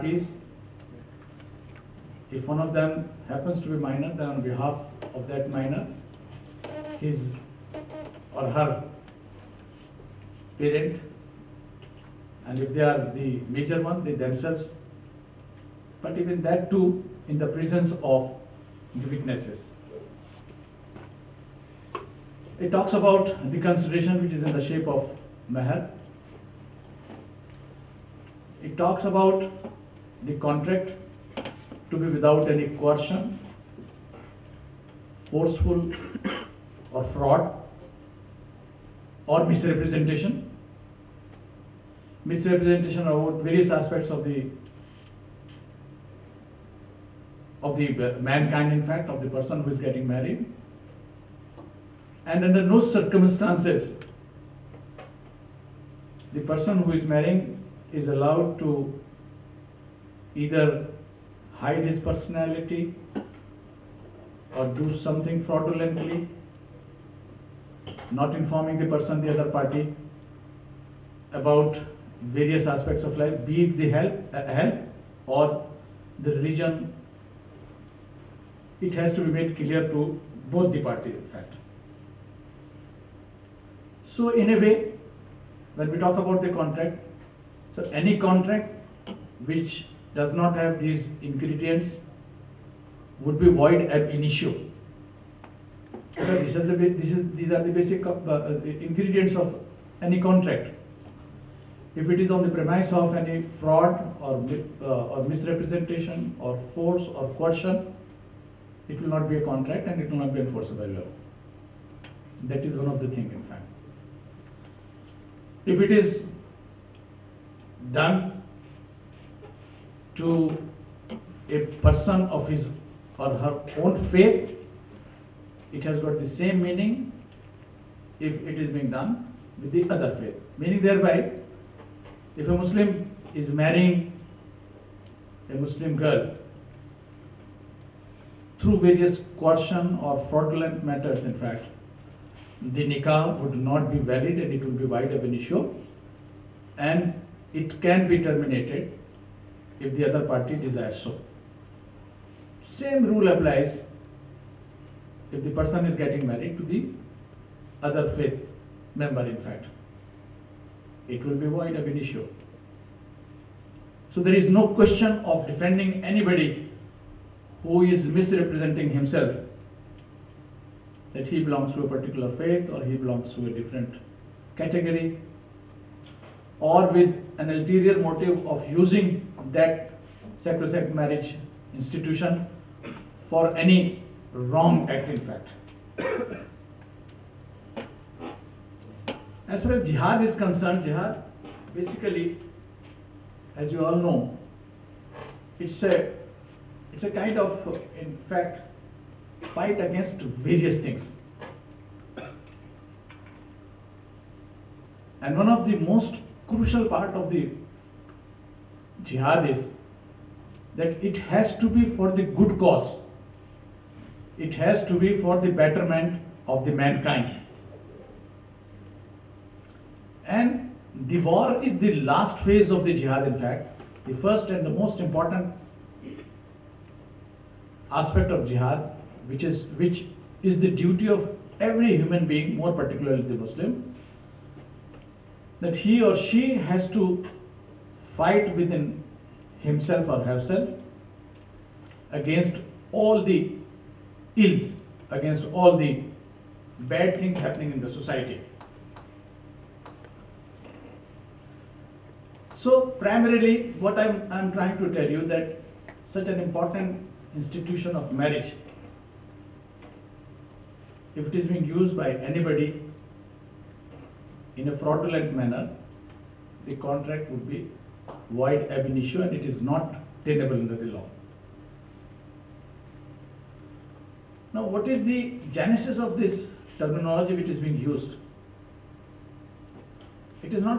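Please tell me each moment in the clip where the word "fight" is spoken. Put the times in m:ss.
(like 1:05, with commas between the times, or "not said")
3:19, 3:58.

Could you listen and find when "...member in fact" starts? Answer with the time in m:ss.
2:38.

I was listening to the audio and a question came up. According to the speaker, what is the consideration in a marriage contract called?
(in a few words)
mahar.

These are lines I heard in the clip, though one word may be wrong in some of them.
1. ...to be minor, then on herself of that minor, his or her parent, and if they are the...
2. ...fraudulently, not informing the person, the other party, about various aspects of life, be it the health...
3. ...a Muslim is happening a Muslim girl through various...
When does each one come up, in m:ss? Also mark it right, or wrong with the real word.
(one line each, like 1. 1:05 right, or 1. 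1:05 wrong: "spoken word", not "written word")
1. 0:03 wrong: "behalf", not "herself"
2. 1:05 right
3. 2:12 wrong: "marrying", not "happening".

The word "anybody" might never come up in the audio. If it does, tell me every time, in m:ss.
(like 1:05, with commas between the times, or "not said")
2:46, 4:22.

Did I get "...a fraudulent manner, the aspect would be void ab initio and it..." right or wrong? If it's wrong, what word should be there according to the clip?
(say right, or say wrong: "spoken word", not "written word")
wrong: "contract", not "aspect".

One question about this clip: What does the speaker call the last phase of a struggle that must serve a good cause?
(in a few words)
war.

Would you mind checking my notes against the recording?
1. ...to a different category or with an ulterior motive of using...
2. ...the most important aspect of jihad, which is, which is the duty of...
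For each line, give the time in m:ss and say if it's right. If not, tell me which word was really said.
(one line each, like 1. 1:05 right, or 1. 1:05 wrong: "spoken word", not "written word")
1. 2:53 right
2. 3:44 right.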